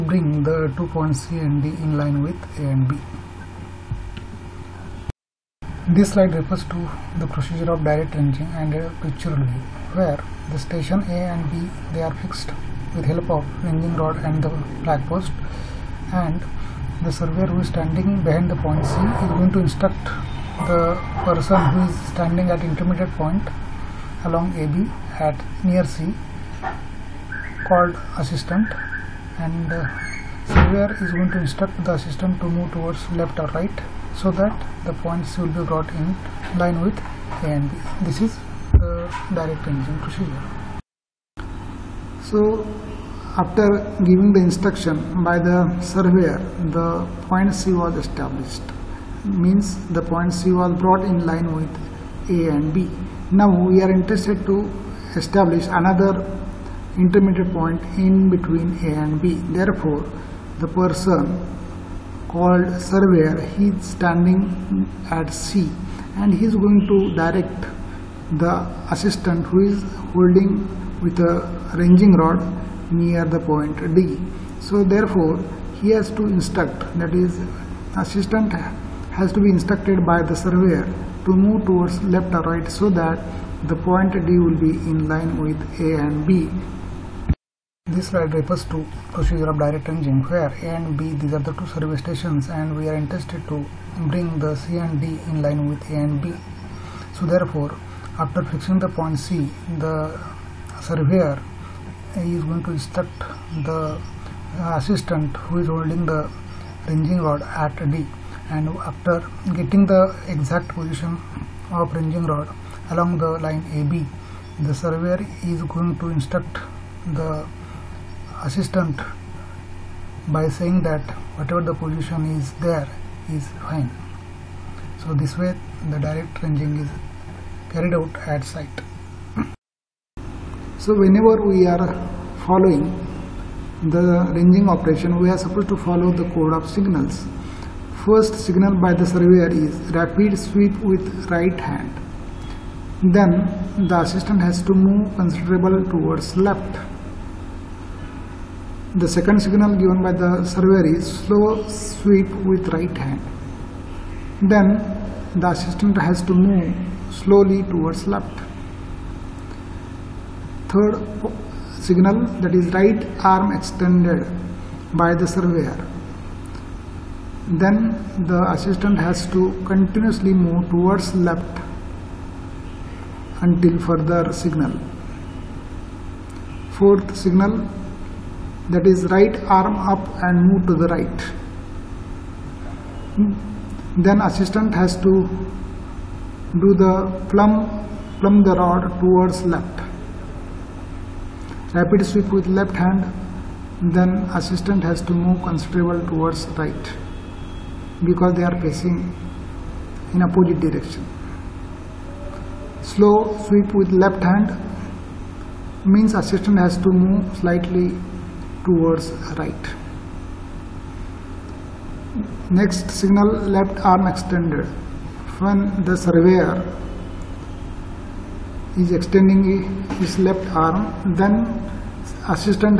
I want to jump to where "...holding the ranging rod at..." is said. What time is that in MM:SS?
01:45.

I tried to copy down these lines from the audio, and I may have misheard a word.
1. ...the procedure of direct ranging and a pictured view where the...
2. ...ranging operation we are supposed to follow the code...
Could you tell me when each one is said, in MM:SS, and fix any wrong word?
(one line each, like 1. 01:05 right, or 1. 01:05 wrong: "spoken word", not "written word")
1. 00:07 right
2. 02:14 right.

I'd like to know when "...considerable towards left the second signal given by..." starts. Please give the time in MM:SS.
02:25.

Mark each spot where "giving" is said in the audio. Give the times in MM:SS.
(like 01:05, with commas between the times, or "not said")
00:44.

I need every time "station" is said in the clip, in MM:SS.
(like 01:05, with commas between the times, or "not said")
00:10, 01:32.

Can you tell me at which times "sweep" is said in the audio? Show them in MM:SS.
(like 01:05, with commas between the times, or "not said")
02:20, 02:31, 03:12, 03:23.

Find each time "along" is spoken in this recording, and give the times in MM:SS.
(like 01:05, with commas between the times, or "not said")
00:24, 01:52.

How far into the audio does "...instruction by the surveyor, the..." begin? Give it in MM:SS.
00:44.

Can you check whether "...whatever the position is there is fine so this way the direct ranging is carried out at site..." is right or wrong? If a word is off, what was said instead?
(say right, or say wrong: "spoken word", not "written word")
right.